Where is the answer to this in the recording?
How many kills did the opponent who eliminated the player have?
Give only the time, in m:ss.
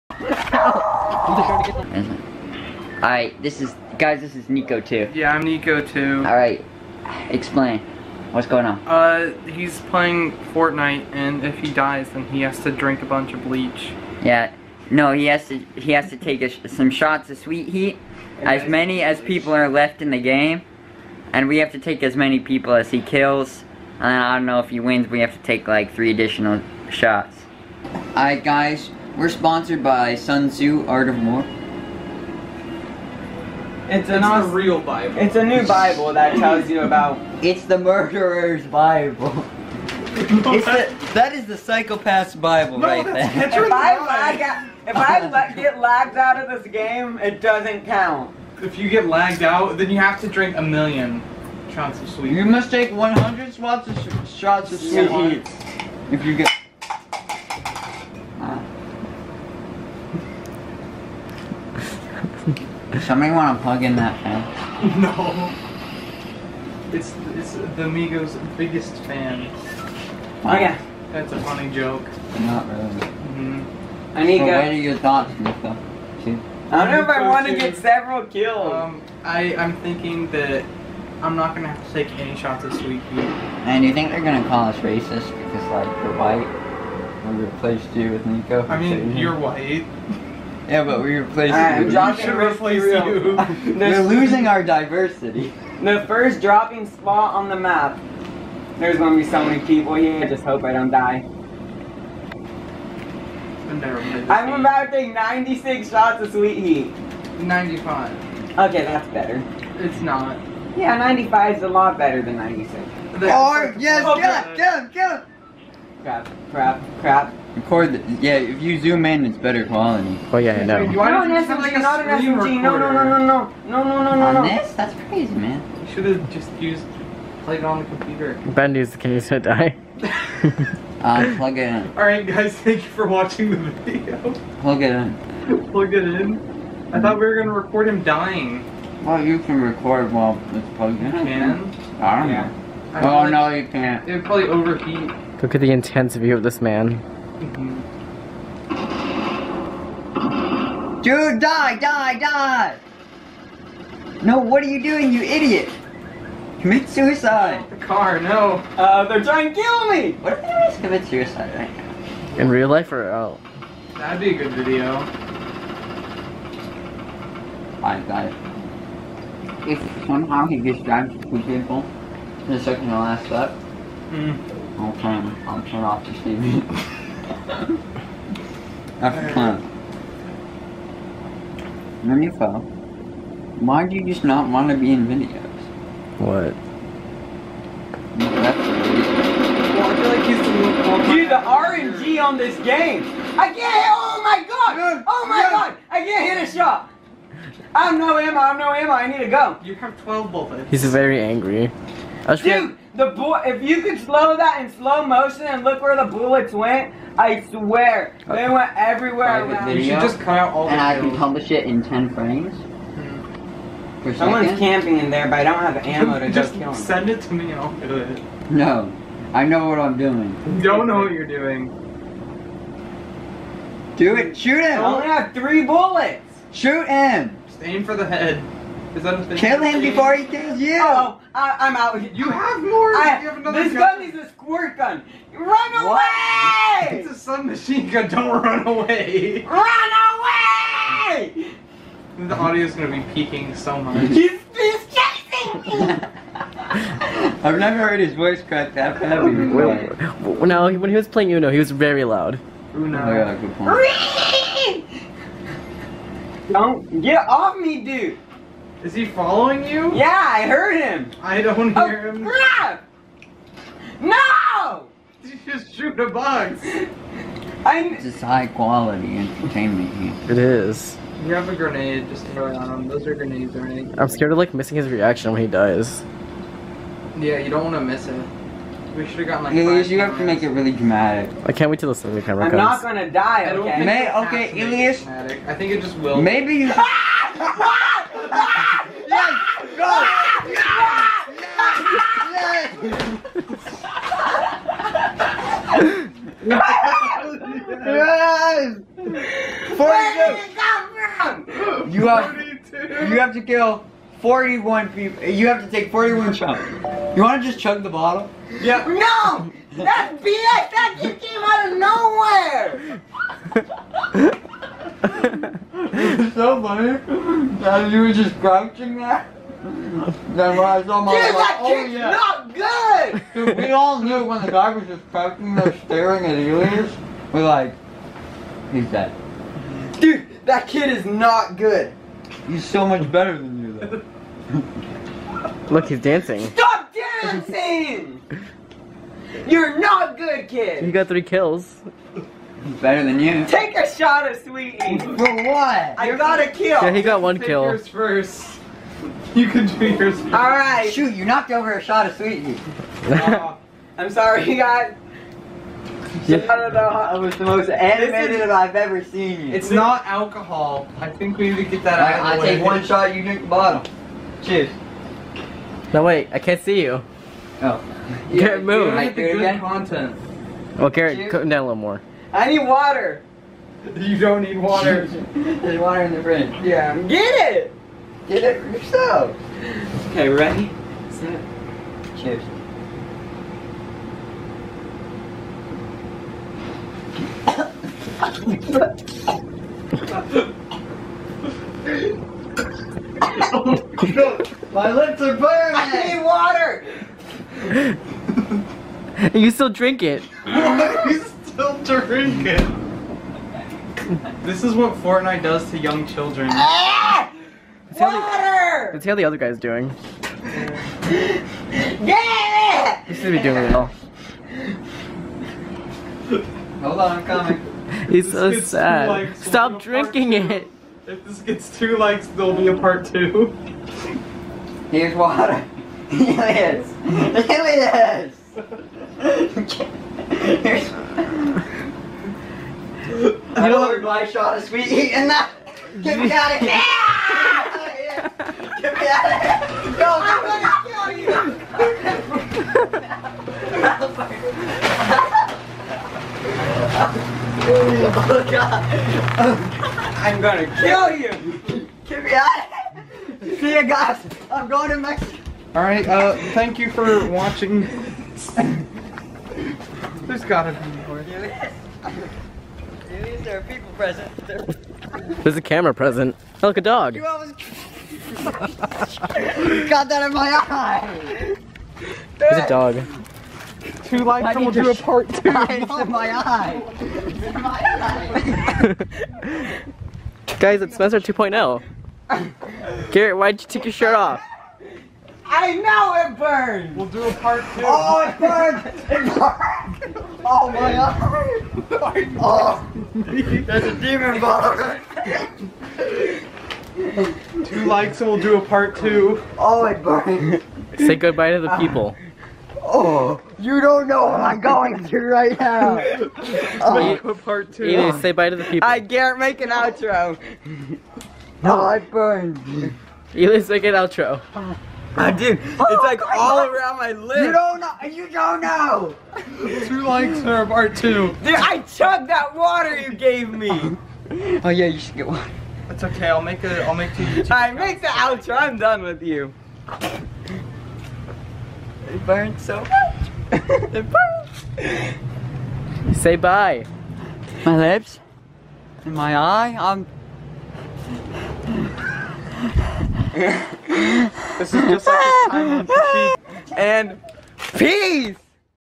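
5:41.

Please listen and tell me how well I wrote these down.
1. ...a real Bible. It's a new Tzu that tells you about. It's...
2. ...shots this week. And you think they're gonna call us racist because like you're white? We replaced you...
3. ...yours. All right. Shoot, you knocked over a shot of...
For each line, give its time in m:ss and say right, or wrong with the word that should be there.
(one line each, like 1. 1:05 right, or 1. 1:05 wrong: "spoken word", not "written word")
1. 0:34 wrong: "Bible", not "Tzu"
2. 1:22 right
3. 5:49 right.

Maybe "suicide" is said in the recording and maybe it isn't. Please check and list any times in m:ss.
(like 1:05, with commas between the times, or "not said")
2:36, 2:41.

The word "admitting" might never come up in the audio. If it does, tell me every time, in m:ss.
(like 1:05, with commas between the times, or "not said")
not said.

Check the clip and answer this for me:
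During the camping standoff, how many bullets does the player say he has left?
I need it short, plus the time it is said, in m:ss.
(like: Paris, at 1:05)
3, at 3:45.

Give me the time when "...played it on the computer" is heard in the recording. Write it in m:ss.
2:07.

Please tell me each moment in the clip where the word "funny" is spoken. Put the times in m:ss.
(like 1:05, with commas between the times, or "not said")
1:11, 5:16.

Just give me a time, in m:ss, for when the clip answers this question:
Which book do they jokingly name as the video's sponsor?
0:30.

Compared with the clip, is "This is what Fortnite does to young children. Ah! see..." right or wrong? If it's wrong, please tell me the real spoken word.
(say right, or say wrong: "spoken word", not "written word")
right.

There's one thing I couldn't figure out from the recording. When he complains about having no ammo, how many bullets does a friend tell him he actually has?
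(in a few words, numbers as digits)
12.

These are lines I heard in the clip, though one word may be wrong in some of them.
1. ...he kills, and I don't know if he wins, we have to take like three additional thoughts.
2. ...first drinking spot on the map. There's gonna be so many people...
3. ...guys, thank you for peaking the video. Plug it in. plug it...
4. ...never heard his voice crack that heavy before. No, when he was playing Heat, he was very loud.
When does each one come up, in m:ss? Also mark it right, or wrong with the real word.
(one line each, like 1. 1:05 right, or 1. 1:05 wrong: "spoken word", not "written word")
1. 0:22 wrong: "shots", not "thoughts"
2. 1:36 wrong: "dropping", not "drinking"
3. 2:12 wrong: "watching", not "peaking"
4. 4:07 wrong: "Uno", not "Heat".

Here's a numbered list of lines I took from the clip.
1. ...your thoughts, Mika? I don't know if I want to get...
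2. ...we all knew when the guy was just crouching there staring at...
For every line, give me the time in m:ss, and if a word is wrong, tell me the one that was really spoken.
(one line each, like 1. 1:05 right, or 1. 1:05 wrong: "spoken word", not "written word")
1. 1:14 right
2. 5:23 right.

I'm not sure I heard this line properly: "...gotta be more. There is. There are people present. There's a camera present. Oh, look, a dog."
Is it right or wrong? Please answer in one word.
right.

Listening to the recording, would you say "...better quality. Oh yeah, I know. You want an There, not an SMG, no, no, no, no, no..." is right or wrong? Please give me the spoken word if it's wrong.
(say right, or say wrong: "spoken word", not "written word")
wrong: "SMG", not "There".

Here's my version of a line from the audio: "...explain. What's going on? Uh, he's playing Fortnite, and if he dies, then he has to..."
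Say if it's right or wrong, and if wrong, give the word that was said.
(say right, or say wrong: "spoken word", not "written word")
right.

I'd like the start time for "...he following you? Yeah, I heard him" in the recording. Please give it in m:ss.
4:18.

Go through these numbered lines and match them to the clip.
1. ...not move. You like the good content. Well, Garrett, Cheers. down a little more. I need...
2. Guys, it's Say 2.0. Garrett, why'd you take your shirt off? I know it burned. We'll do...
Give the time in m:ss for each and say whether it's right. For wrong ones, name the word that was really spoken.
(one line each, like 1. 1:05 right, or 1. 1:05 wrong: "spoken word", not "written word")
1. 6:08 right
2. 8:00 wrong: "Spencer", not "Say".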